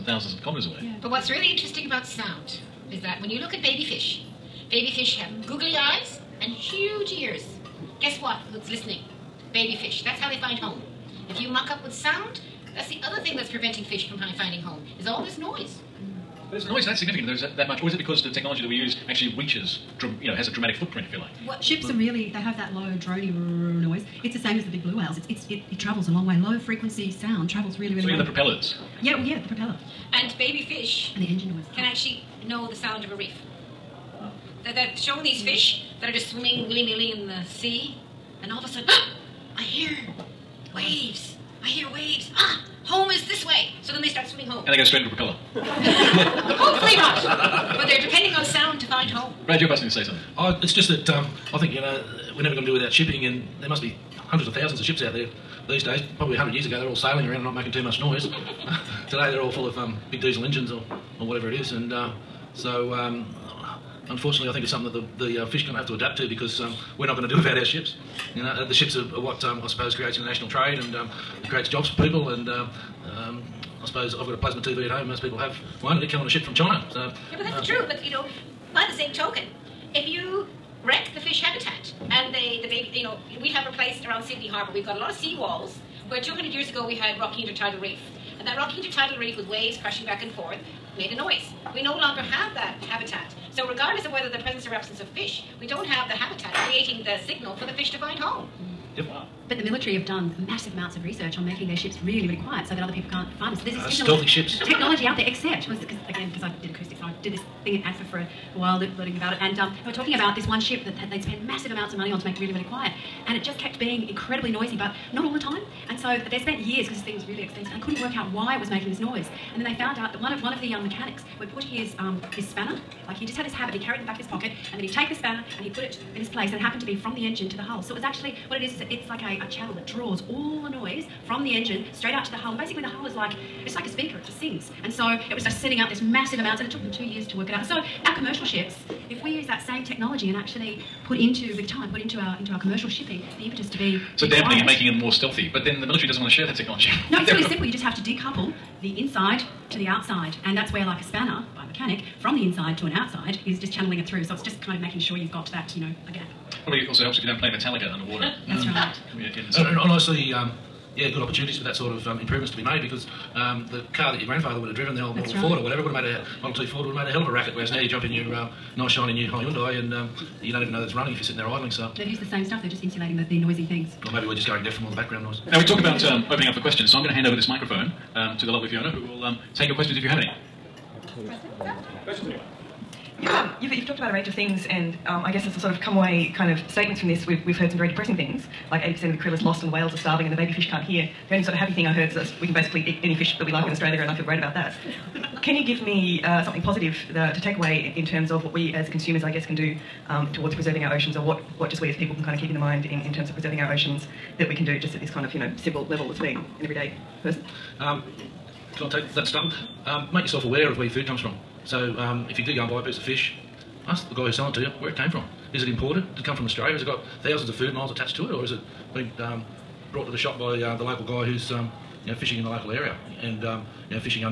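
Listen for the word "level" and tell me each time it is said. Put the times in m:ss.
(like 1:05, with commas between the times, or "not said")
3:25.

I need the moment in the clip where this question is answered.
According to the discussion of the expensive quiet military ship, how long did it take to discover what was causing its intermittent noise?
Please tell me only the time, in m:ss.
2:16.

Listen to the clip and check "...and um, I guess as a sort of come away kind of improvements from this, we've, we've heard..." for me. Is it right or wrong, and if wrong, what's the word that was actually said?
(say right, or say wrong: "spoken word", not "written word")
wrong: "statements", not "improvements".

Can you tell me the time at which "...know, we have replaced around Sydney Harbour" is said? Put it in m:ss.
1:23.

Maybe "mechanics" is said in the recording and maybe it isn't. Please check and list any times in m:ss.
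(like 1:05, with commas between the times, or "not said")
2:00, 2:31.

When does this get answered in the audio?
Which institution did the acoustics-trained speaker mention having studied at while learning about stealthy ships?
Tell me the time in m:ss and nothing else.
1:47.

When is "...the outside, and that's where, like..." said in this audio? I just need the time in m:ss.
2:29.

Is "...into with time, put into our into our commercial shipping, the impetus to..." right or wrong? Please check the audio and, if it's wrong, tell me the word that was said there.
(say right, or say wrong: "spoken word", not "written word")
right.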